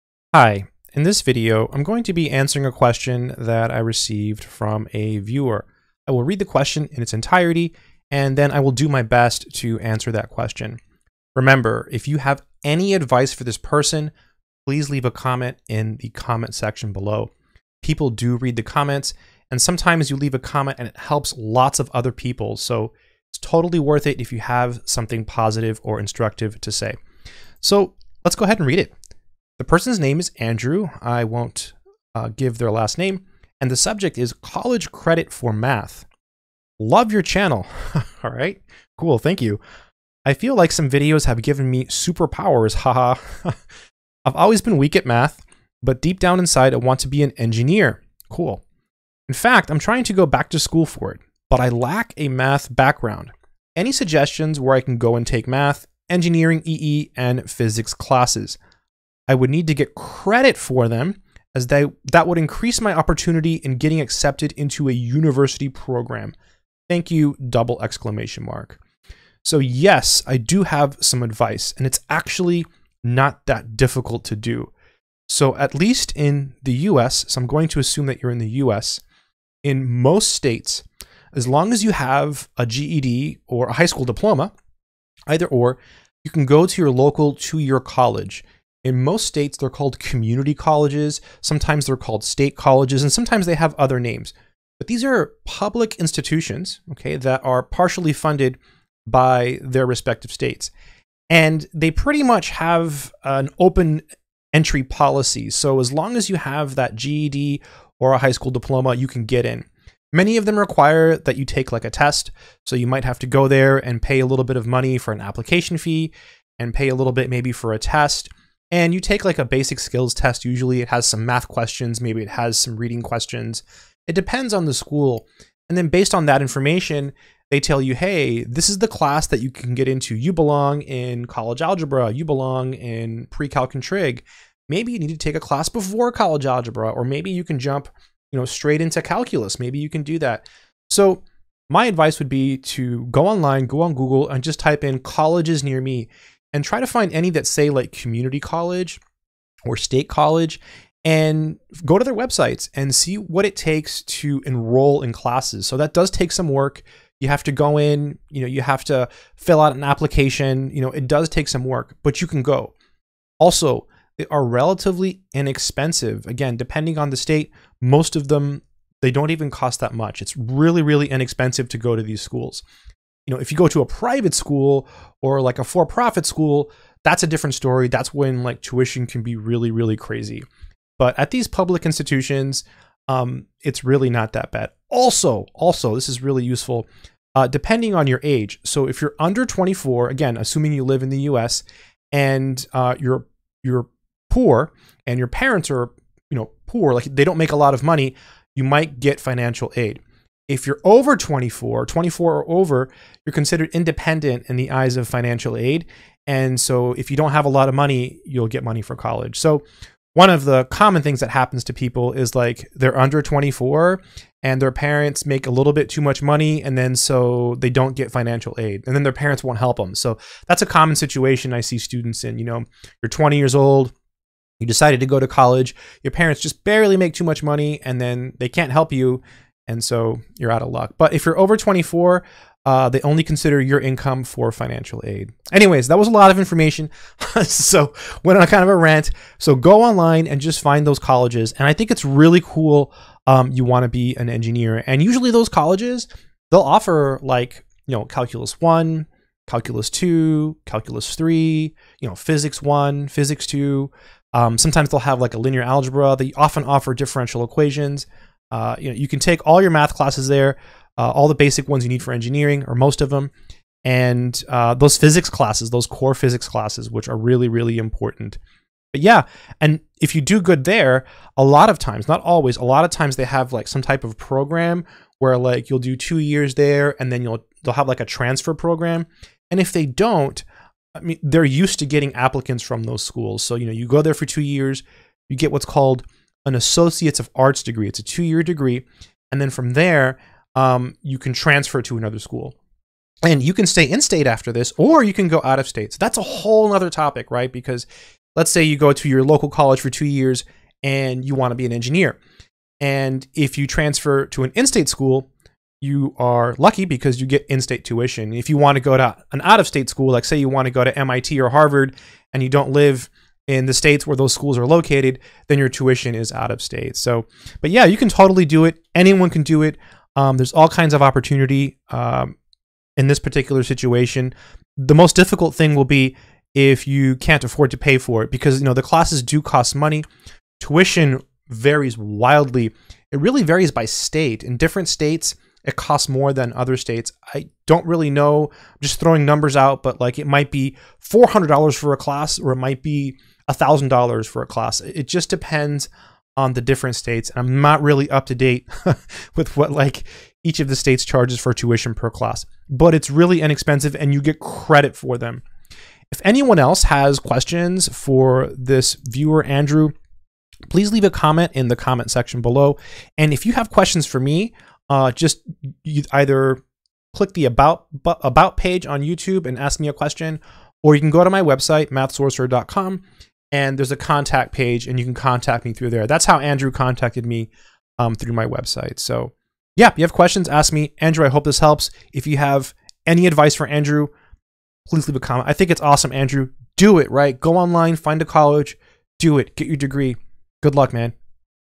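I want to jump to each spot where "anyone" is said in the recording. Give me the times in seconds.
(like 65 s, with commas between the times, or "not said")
318 s, 356 s.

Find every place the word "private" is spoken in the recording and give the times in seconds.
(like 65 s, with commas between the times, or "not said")
173 s.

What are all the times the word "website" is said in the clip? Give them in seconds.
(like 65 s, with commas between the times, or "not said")
152 s, 371 s, 378 s.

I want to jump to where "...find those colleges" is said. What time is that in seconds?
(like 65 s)
240 s.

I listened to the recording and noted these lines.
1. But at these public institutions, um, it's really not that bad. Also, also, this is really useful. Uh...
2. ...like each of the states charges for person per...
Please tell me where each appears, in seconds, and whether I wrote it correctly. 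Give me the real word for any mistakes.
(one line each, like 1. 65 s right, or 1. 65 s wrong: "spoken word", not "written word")
1. 180 s right
2. 349 s wrong: "tuition", not "person".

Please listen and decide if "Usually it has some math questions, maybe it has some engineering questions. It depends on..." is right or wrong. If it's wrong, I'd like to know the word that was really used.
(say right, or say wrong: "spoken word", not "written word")
wrong: "reading", not "engineering".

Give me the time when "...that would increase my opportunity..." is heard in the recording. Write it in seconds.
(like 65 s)
62 s.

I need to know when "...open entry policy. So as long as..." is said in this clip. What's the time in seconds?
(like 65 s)
103 s.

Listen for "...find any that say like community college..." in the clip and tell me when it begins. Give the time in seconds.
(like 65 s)
146 s.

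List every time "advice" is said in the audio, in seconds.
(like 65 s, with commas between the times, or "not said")
12 s, 71 s, 141 s, 383 s.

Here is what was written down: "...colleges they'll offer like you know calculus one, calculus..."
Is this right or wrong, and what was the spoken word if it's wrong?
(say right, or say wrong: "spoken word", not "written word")
right.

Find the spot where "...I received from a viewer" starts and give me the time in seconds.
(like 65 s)
3 s.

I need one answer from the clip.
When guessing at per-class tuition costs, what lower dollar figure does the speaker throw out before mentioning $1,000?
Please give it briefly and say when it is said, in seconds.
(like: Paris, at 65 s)
$400, at 341 s.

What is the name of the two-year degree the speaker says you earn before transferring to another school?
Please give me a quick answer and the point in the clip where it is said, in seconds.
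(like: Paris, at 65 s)
Associates of Arts degree, at 286 s.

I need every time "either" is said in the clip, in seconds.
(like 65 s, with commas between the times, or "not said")
85 s, 366 s.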